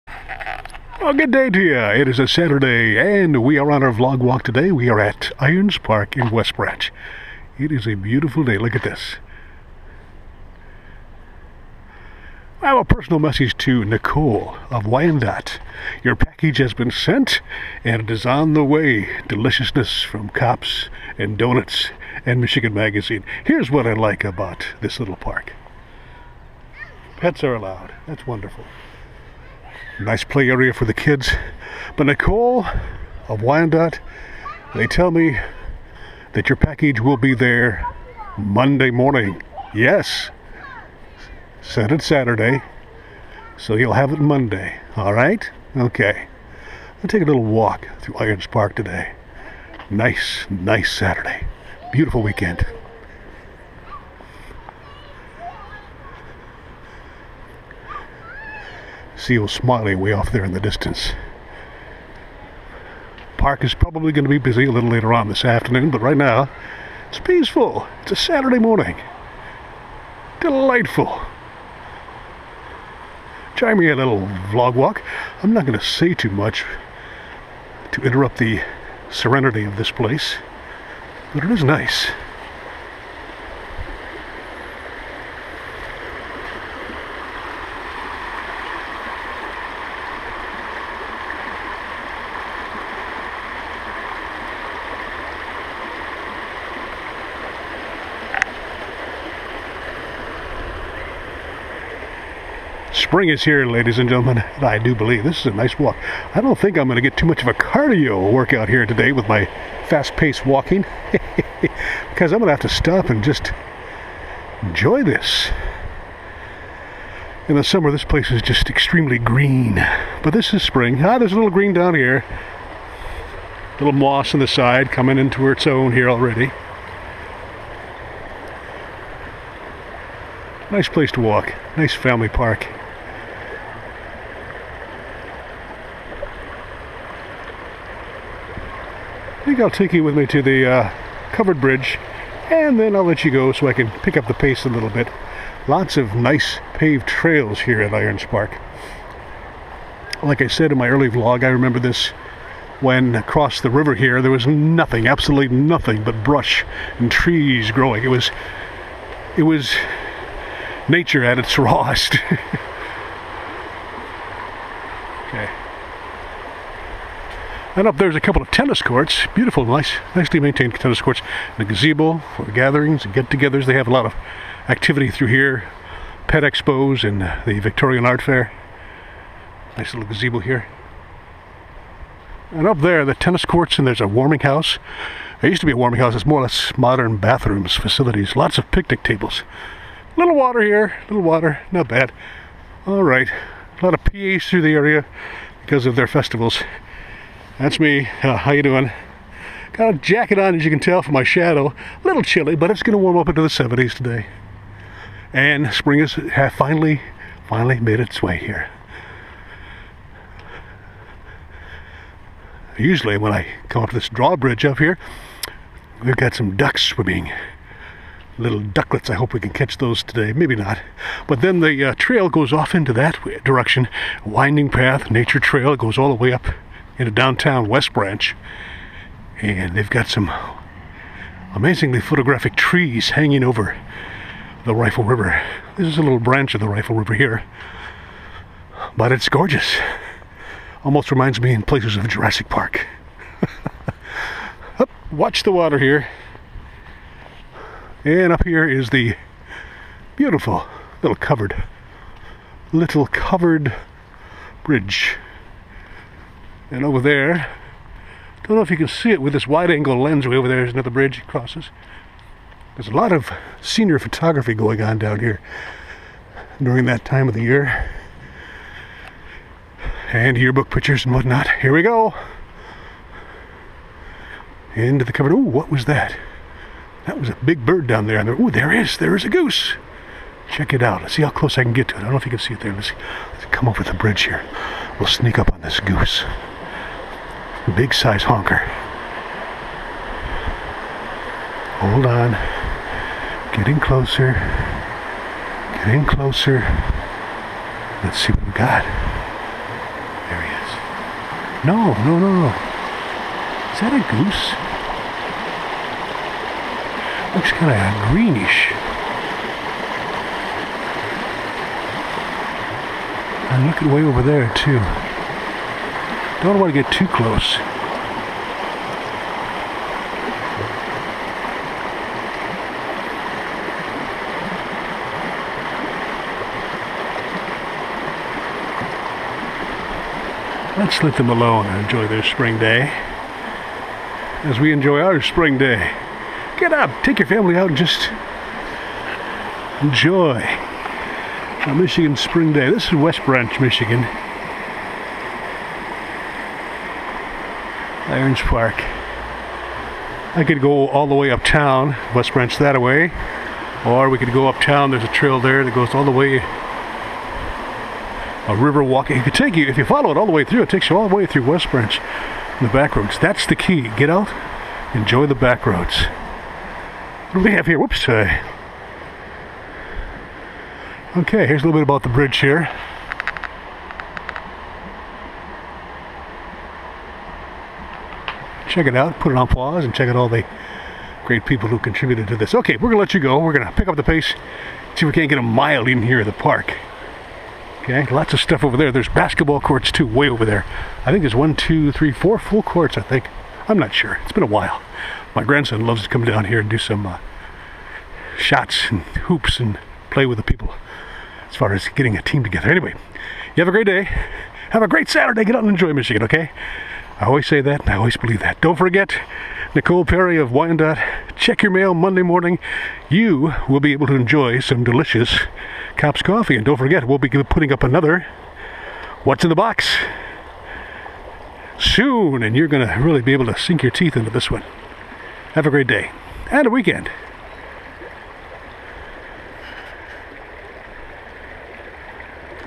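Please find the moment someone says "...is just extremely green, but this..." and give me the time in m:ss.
1:58.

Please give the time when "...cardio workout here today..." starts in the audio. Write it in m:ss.
1:47.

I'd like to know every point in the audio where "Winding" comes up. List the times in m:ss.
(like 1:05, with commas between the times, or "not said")
3:44.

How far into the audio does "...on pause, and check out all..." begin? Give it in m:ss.
6:19.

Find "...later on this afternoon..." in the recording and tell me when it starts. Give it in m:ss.
1:04.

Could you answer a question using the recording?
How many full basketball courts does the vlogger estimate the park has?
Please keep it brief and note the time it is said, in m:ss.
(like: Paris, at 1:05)
4, at 6:32.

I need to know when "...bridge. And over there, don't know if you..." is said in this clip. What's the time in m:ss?
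4:14.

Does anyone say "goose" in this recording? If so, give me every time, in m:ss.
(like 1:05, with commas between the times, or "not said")
4:39, 4:45, 5:04.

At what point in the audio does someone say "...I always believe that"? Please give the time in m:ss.
6:47.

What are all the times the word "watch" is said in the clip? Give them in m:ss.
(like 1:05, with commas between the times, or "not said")
4:05.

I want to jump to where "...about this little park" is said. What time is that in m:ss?
0:24.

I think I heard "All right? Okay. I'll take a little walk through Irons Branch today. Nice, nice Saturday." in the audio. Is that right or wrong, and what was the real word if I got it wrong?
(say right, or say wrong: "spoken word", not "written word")
wrong: "Park", not "Branch".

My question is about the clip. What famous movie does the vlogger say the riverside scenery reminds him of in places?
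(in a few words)
Jurassic Park.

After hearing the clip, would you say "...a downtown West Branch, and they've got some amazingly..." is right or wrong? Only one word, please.
right.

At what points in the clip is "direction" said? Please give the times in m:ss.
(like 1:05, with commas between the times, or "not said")
3:43.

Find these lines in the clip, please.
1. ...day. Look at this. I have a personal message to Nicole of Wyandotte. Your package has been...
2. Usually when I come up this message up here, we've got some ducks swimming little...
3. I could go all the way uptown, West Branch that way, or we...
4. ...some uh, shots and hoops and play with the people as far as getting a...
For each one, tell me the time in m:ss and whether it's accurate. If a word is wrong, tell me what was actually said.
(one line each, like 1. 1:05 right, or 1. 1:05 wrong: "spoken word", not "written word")
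1. 0:08 right
2. 3:32 wrong: "drawbridge", not "message"
3. 5:50 right
4. 6:36 right.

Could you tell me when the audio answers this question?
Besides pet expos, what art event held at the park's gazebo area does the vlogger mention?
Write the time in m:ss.
2:57.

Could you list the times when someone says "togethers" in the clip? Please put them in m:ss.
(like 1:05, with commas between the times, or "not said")
2:53, 6:42.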